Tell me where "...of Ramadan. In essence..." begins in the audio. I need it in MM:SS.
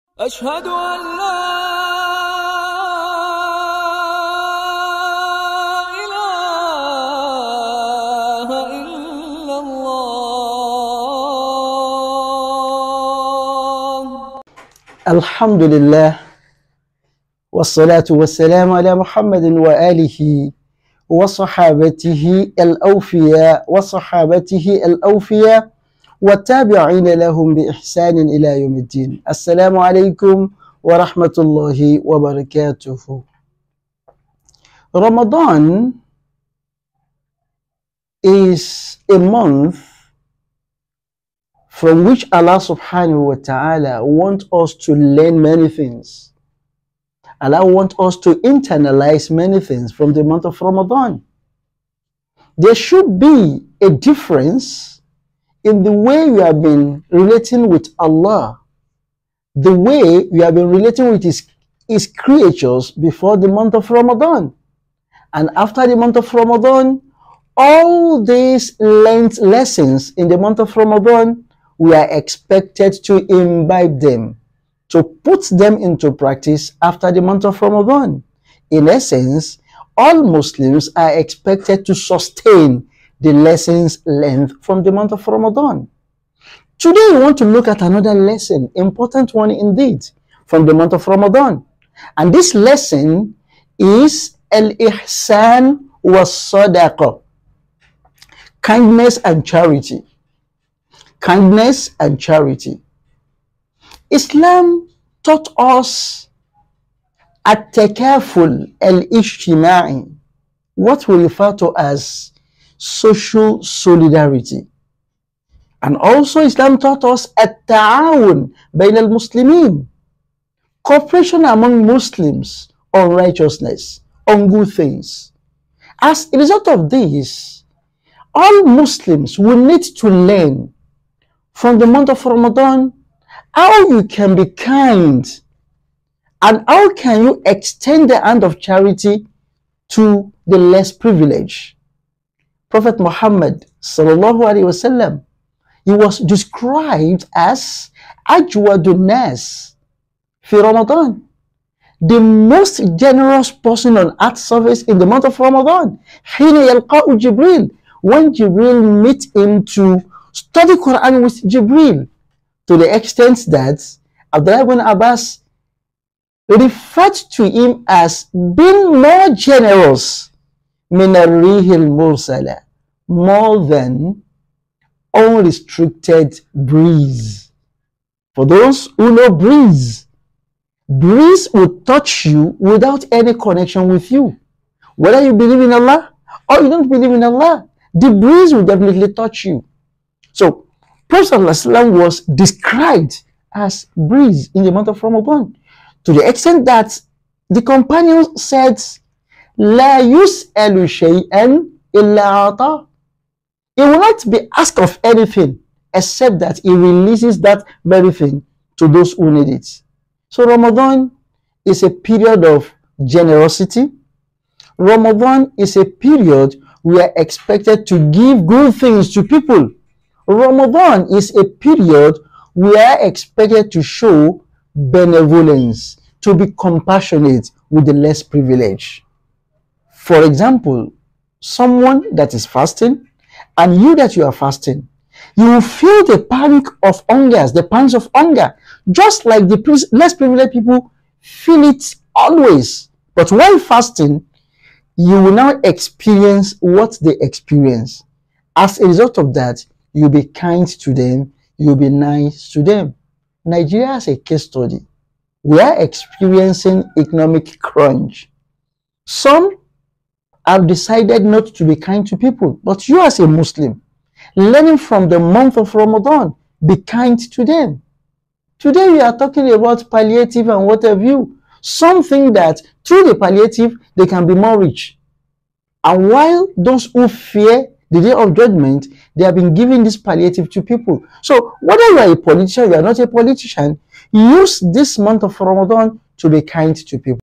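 01:17.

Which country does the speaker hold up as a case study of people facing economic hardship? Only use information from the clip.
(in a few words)
Nigeria.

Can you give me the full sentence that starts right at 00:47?
Allah wants us to internalize many things from the month of Ramadan.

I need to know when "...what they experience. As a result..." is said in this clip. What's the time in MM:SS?
04:06.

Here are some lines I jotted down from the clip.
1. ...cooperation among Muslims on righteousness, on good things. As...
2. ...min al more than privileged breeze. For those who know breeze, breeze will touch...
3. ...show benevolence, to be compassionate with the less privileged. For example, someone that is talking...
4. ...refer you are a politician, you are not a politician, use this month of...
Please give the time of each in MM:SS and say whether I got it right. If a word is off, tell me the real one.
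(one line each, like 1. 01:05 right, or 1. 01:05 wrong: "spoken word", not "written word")
1. 02:00 right
2. 02:50 wrong: "unrestricted", not "privileged"
3. 03:43 wrong: "fasting", not "talking"
4. 04:41 wrong: "whether", not "refer".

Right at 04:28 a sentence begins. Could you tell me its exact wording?
Today we are talking about palliative and what have you.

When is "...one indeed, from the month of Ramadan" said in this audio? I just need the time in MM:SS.
01:29.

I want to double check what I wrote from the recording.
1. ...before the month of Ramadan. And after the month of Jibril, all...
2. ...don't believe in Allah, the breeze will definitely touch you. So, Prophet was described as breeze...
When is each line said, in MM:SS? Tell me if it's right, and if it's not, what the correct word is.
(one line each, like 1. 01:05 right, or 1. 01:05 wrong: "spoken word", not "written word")
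1. 01:02 wrong: "Ramadan", not "Jibril"
2. 03:06 right.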